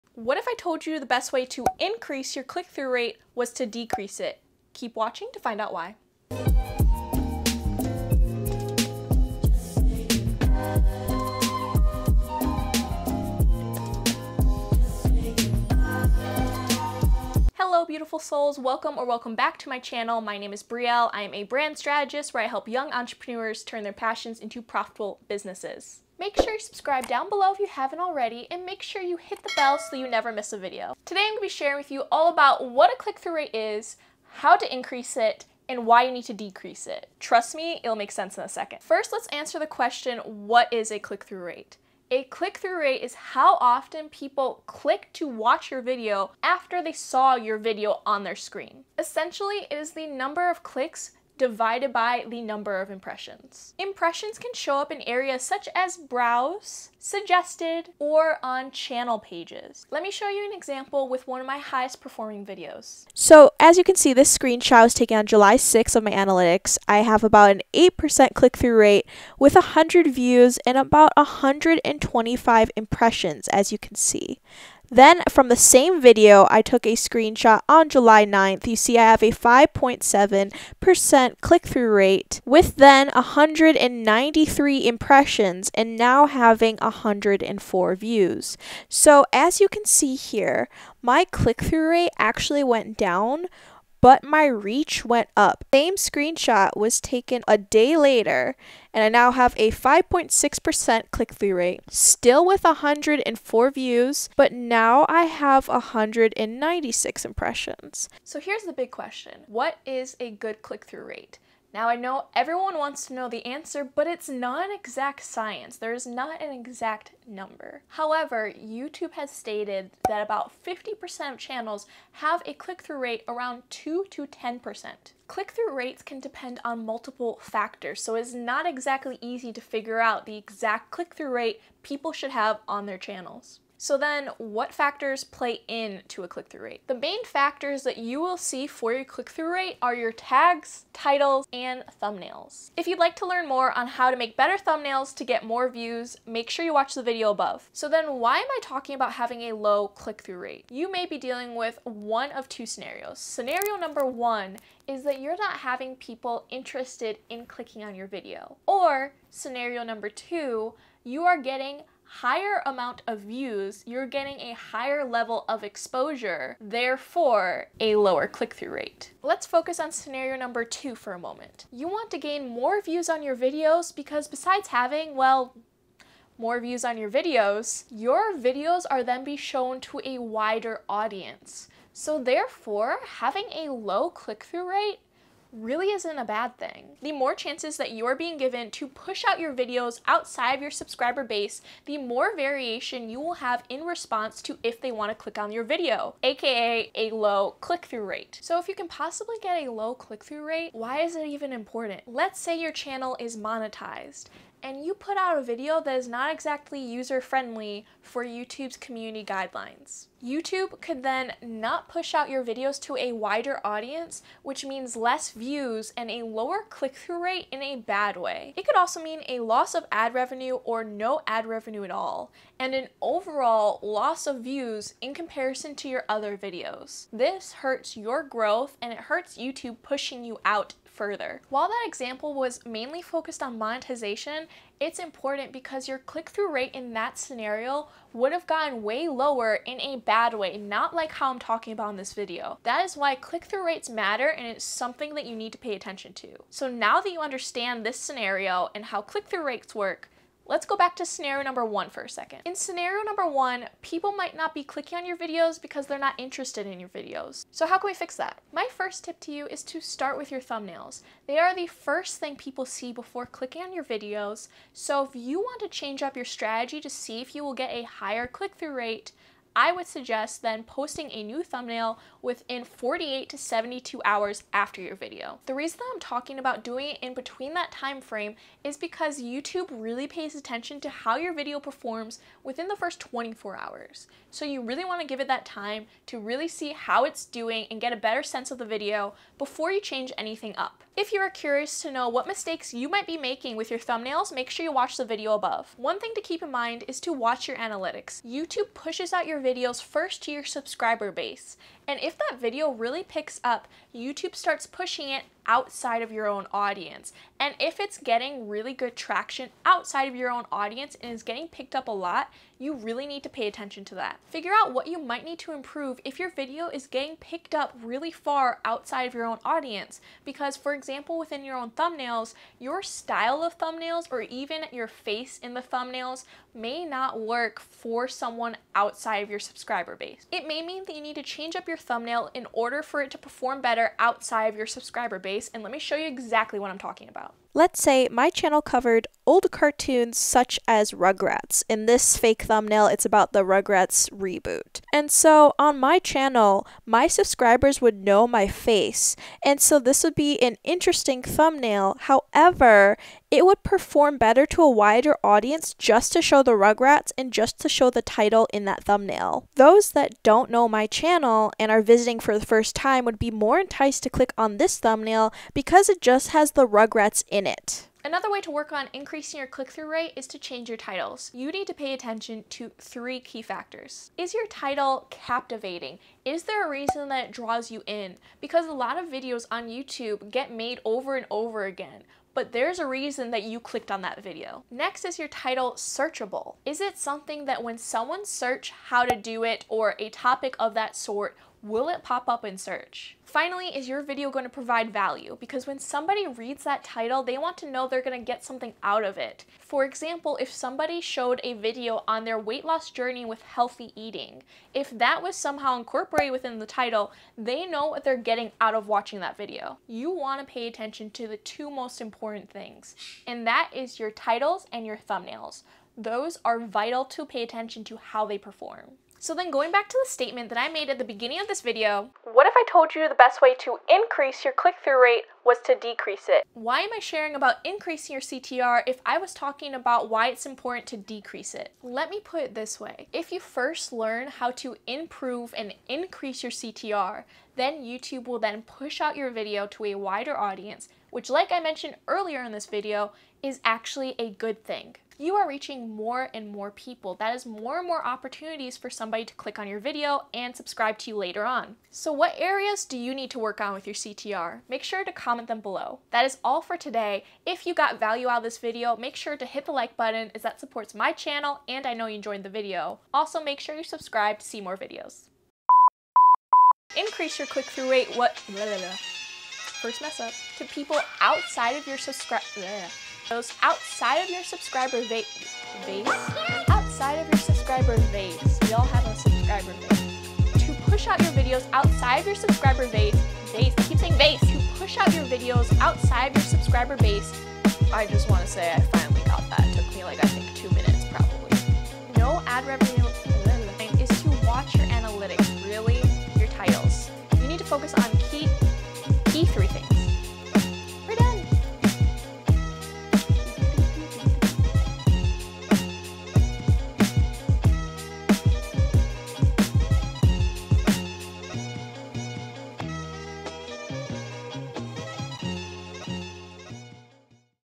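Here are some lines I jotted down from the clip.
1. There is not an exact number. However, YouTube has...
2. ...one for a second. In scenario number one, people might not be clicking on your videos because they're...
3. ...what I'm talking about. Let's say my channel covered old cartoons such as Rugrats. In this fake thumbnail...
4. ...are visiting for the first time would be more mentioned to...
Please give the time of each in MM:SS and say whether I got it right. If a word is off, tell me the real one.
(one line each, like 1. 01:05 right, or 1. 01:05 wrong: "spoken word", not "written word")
1. 01:55 right
2. 04:11 right
3. 05:36 right
4. 06:01 wrong: "enticed", not "mentioned".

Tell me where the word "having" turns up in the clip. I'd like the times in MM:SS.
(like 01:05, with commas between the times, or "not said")
01:26, 02:29, 02:35, 02:54, 03:03.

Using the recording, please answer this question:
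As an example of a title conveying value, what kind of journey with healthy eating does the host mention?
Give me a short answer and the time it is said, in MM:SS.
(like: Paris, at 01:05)
weight loss journey, at 06:42.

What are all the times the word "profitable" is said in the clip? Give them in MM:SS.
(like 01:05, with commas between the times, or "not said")
00:24.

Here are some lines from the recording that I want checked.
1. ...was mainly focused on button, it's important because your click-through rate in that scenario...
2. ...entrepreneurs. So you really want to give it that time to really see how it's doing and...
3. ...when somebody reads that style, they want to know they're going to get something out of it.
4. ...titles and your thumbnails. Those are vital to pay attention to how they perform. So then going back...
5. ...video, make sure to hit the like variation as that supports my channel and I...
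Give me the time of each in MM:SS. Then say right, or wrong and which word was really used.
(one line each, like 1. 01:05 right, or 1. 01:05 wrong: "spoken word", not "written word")
1. 03:52 wrong: "monetization", not "button"
2. 04:43 wrong: "hours", not "entrepreneurs"
3. 06:35 wrong: "title", not "style"
4. 06:54 right
5. 07:38 wrong: "button", not "variation".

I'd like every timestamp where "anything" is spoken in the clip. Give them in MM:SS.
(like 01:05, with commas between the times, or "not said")
04:50.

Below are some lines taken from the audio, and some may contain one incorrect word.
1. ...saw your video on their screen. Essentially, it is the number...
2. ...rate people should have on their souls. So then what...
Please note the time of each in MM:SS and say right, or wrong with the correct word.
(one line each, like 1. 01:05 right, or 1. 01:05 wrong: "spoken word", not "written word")
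1. 00:46 right
2. 02:11 wrong: "channels", not "souls".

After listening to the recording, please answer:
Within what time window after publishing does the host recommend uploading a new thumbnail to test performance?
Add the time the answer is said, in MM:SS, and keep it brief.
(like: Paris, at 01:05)
48 to 72 hours, at 04:32.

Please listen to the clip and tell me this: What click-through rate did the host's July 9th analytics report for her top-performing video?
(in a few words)
5.7%.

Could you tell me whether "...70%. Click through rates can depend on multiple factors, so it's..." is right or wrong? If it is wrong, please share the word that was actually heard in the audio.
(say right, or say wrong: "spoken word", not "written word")
wrong: "10", not "70".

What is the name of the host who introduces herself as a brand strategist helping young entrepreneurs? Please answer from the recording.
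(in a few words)
Brielle.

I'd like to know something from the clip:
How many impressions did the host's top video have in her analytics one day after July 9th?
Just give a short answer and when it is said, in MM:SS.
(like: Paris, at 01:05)
196, at 01:45.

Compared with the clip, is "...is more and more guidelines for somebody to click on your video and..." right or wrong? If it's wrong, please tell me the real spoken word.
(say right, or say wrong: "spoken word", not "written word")
wrong: "opportunities", not "guidelines".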